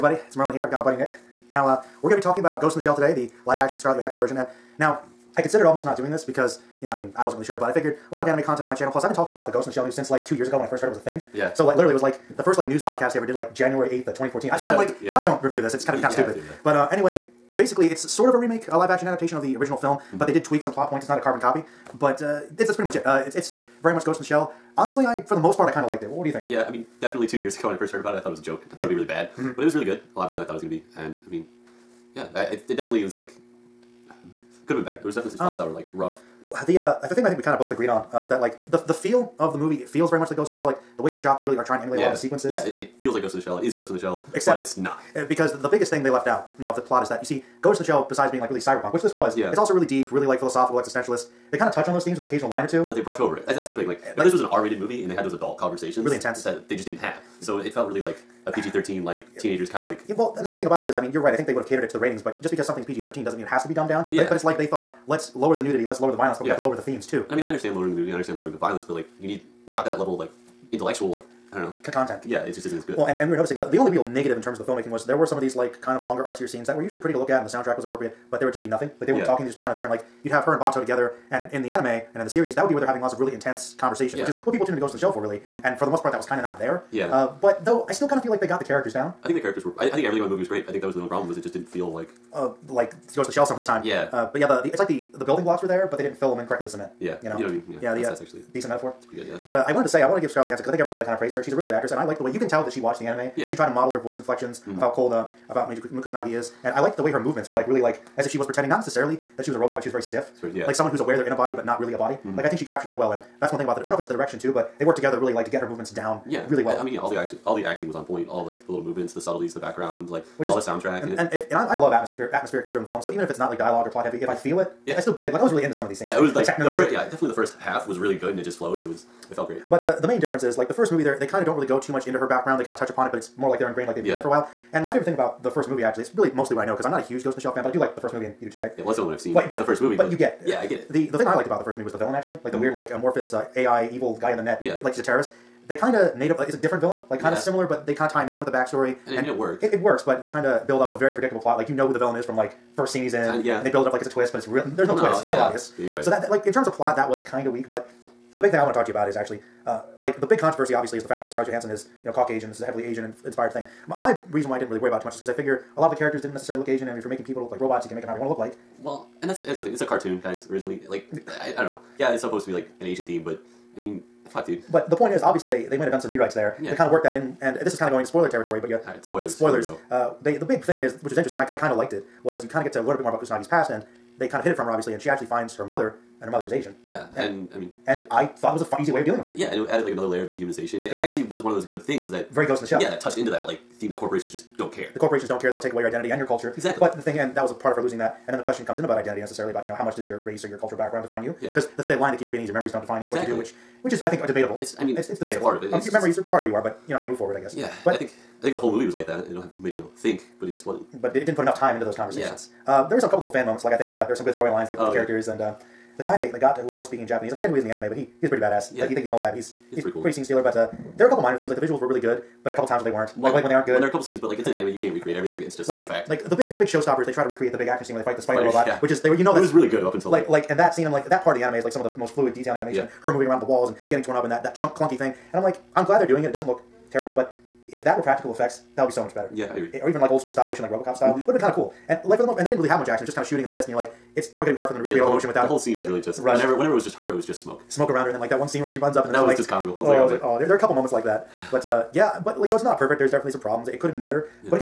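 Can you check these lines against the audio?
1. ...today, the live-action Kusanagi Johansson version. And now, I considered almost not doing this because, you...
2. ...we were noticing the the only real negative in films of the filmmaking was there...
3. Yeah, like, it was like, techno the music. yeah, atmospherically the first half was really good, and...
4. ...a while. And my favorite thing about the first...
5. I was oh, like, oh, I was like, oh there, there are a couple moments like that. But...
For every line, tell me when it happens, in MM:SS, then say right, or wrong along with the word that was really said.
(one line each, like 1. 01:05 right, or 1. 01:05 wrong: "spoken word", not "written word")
1. 00:02 wrong: "Scarlett", not "Kusanagi"
2. 01:13 wrong: "terms", not "films"
3. 02:06 wrong: "definitely", not "atmospherically"
4. 02:14 right
5. 04:09 right.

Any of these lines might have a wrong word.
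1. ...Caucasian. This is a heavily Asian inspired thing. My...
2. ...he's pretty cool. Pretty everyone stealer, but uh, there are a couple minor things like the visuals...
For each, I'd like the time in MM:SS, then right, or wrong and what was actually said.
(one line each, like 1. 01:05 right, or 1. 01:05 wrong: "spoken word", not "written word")
1. 02:42 right
2. 03:39 wrong: "scene", not "everyone".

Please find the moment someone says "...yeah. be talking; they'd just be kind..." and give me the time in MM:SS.
01:19.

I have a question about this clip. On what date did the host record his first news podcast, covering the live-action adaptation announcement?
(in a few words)
January 8, 2014.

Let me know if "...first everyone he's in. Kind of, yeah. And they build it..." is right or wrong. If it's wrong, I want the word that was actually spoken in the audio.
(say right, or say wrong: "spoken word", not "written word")
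wrong: "scene", not "everyone".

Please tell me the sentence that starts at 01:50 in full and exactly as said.
Like someone who's aware they're in a body but not really a body.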